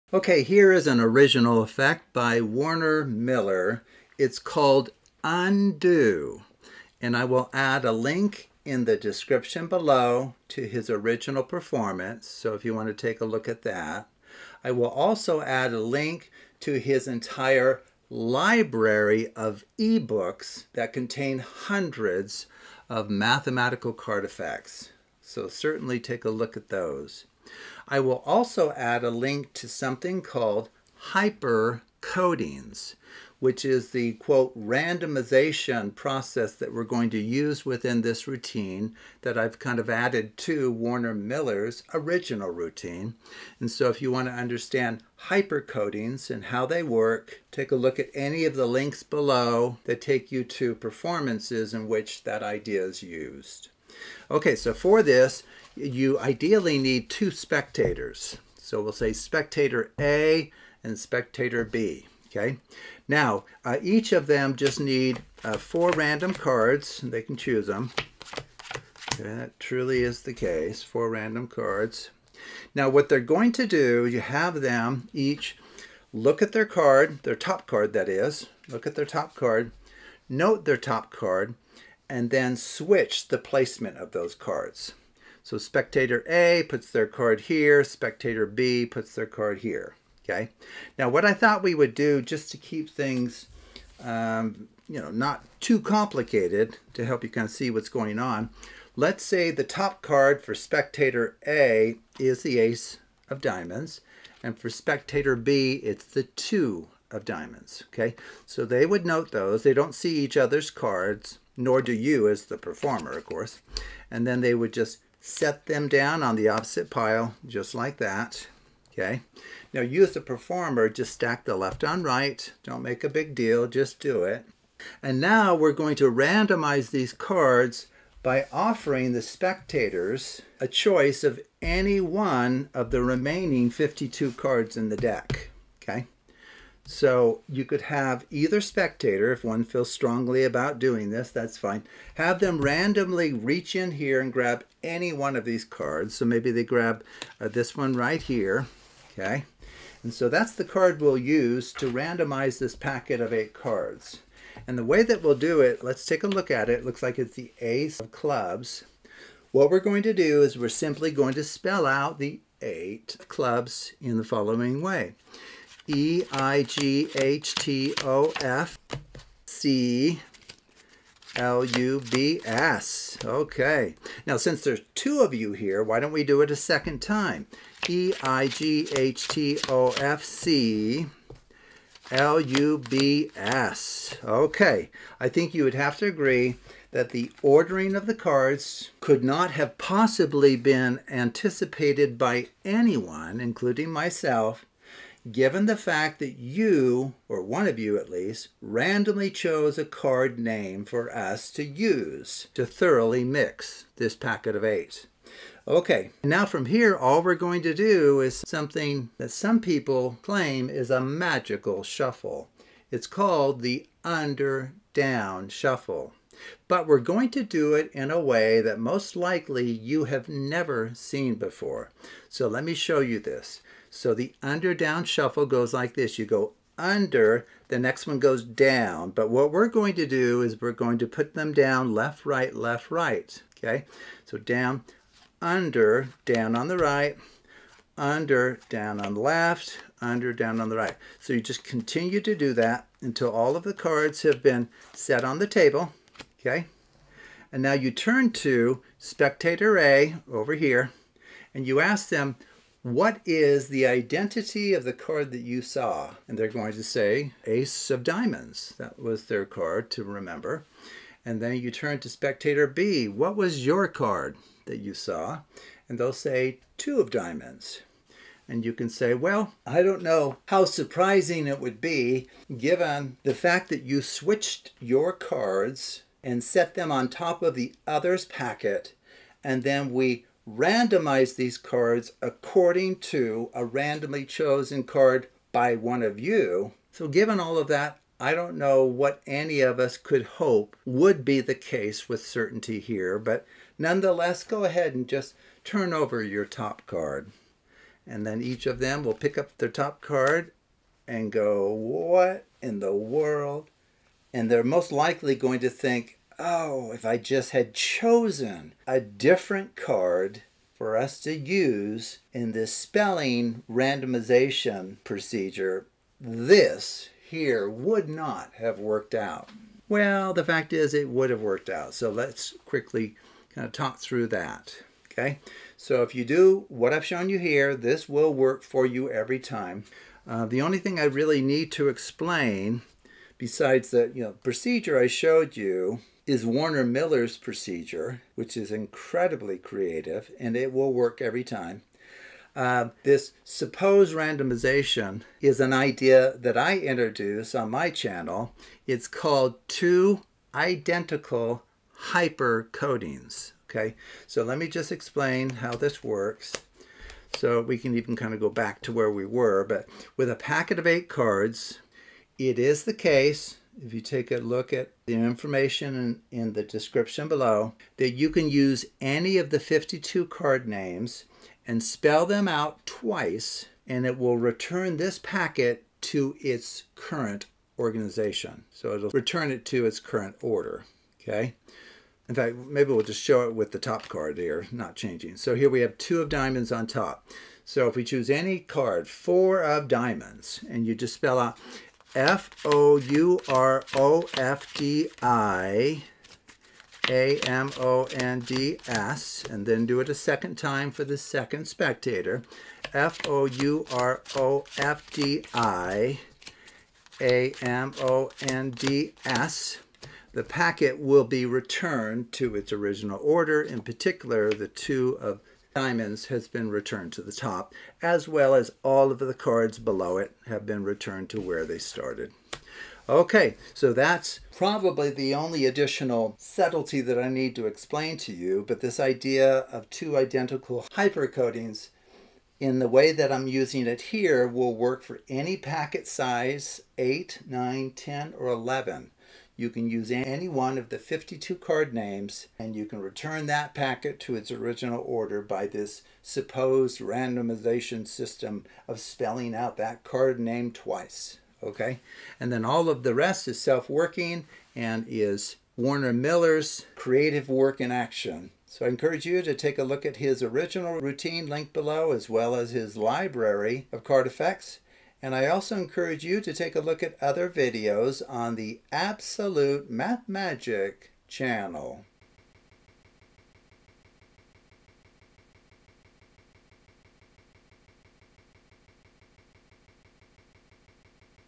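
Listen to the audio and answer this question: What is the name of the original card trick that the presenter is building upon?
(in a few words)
Undo.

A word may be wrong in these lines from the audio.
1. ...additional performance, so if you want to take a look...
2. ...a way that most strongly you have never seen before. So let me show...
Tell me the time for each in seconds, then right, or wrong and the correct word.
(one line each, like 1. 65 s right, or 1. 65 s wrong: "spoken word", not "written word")
1. 10 s wrong: "original", not "additional"
2. 218 s wrong: "likely", not "strongly".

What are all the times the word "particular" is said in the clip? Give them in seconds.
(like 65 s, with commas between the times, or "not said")
413 s.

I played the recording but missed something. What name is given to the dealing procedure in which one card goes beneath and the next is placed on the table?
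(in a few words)
under-down shuffle.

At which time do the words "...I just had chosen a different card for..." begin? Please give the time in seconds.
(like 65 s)
307 s.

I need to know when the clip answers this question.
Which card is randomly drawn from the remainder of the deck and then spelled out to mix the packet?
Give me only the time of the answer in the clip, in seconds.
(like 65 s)
157 s.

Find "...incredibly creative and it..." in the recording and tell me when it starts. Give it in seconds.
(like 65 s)
338 s.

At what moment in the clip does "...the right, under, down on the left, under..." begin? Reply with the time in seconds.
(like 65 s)
236 s.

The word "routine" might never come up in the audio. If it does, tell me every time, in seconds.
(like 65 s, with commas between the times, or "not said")
38 s, 42 s, 460 s.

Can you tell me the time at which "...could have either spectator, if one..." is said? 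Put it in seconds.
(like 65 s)
137 s.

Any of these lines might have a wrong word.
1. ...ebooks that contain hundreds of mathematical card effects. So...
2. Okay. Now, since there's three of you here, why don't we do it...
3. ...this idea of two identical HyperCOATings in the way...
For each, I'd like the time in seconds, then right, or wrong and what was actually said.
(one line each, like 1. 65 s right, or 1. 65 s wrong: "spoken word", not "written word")
1. 19 s right
2. 173 s wrong: "two", not "three"
3. 428 s right.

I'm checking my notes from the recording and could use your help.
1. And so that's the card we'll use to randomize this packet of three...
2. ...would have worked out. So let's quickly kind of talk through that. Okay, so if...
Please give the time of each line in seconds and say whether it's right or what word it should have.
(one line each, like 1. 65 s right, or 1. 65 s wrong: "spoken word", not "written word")
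1. 150 s wrong: "eight", not "three"
2. 321 s right.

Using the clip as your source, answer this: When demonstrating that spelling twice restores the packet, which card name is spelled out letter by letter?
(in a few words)
Four of diamonds.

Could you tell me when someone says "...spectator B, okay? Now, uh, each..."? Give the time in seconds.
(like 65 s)
60 s.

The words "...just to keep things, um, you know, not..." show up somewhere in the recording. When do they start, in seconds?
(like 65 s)
92 s.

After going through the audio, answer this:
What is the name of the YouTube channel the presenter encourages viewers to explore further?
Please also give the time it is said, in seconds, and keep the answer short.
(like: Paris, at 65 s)
Absolute Math Magic, at 468 s.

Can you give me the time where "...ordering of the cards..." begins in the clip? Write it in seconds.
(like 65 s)
187 s.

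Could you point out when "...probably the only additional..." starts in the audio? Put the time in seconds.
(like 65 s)
424 s.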